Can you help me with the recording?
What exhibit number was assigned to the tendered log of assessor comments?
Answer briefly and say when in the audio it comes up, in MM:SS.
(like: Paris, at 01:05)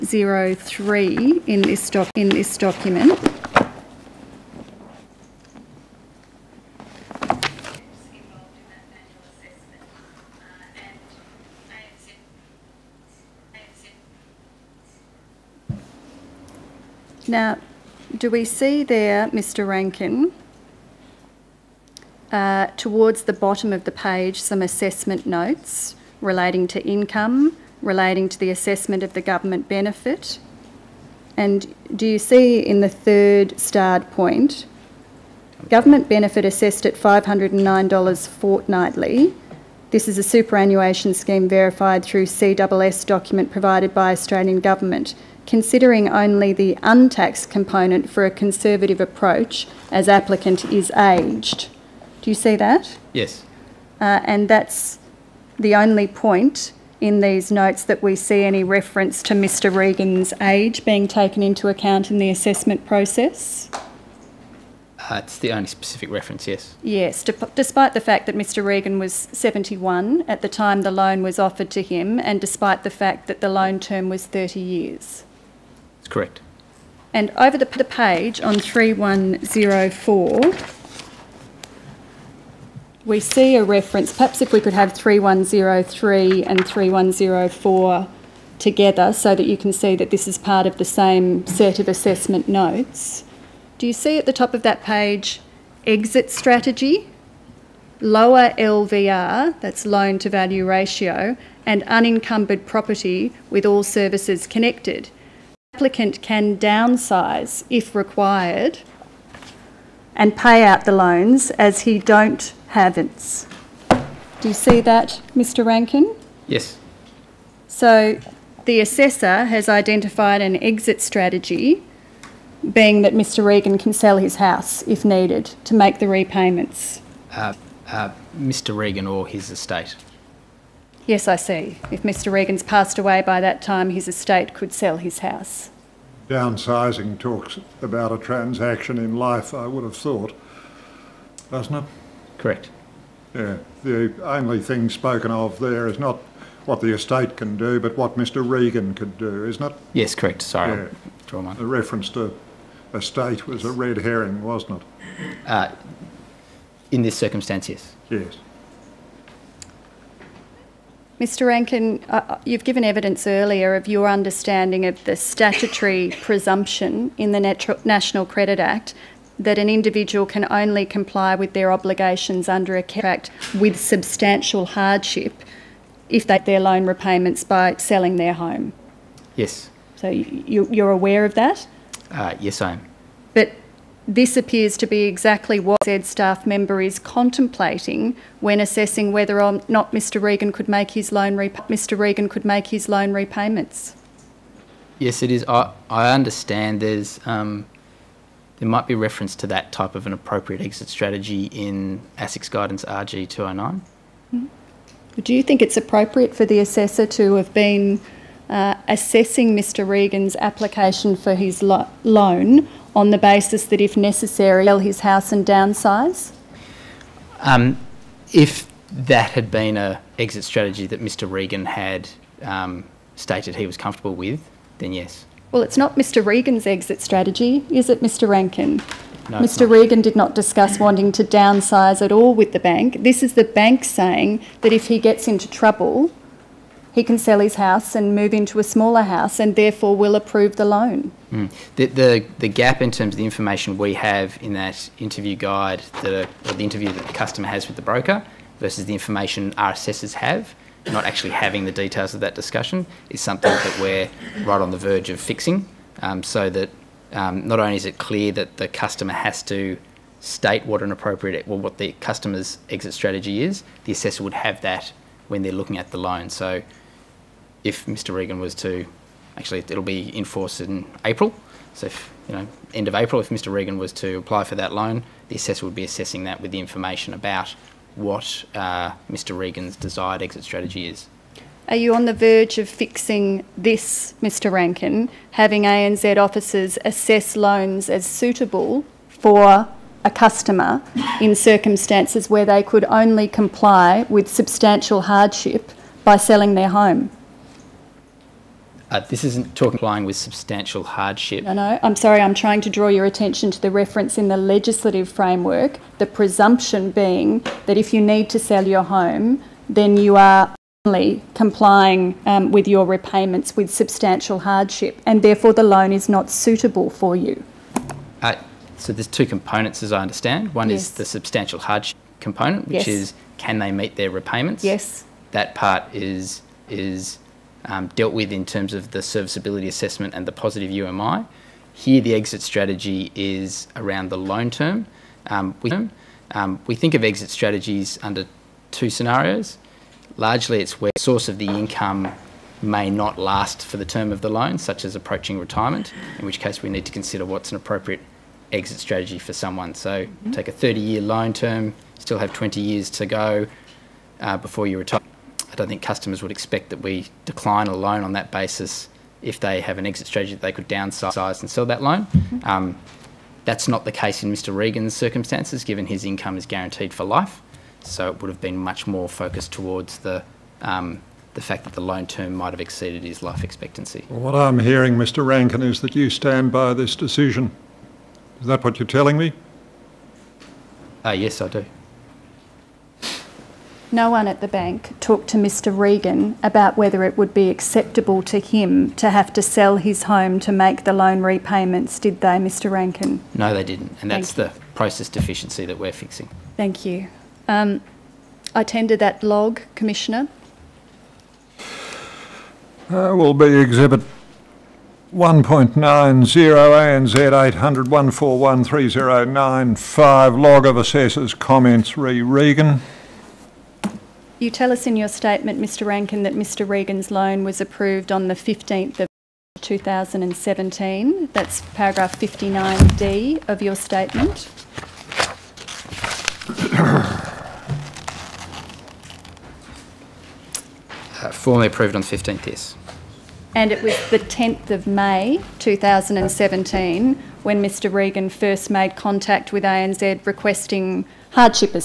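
Exhibit 1.90, at 06:43.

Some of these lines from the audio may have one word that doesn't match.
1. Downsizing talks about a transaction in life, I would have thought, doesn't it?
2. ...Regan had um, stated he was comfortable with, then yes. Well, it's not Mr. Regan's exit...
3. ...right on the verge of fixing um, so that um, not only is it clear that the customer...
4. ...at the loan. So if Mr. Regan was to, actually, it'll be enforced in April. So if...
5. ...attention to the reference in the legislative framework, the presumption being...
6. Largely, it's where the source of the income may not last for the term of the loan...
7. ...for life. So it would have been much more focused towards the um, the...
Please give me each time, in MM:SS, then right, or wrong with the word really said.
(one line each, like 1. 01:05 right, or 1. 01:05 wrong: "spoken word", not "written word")
1. 02:16 right
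2. 03:41 right
3. 04:14 right
4. 04:25 right
5. 05:03 right
6. 05:40 right
7. 06:06 right.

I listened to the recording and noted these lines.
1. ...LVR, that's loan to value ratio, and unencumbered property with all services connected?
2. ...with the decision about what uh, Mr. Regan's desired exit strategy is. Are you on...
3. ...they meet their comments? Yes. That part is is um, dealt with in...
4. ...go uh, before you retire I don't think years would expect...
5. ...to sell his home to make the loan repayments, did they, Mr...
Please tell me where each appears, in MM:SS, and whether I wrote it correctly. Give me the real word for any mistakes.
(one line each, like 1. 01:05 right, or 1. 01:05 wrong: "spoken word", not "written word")
1. 01:38 right
2. 04:36 wrong: "information", not "decision"
3. 05:23 wrong: "repayments", not "comments"
4. 05:53 wrong: "customers", not "years"
5. 06:29 right.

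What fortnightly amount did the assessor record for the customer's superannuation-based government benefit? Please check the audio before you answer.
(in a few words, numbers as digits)
$509.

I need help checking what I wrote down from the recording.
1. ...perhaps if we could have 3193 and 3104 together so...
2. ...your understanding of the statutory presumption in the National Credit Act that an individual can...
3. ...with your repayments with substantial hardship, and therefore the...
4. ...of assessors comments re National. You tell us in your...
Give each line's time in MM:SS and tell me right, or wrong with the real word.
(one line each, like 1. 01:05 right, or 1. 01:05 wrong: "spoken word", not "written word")
1. 01:24 wrong: "3103", not "3193"
2. 02:43 right
3. 05:12 right
4. 06:50 wrong: "Regan", not "National".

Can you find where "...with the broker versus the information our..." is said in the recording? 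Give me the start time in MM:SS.
04:07.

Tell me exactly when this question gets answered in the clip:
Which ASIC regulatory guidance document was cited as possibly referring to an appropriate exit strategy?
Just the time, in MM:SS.
03:22.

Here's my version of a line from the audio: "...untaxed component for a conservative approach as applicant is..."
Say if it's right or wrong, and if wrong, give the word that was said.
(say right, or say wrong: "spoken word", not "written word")
right.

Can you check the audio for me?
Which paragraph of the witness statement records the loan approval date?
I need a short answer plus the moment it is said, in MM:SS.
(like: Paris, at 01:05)
59D, at 07:02.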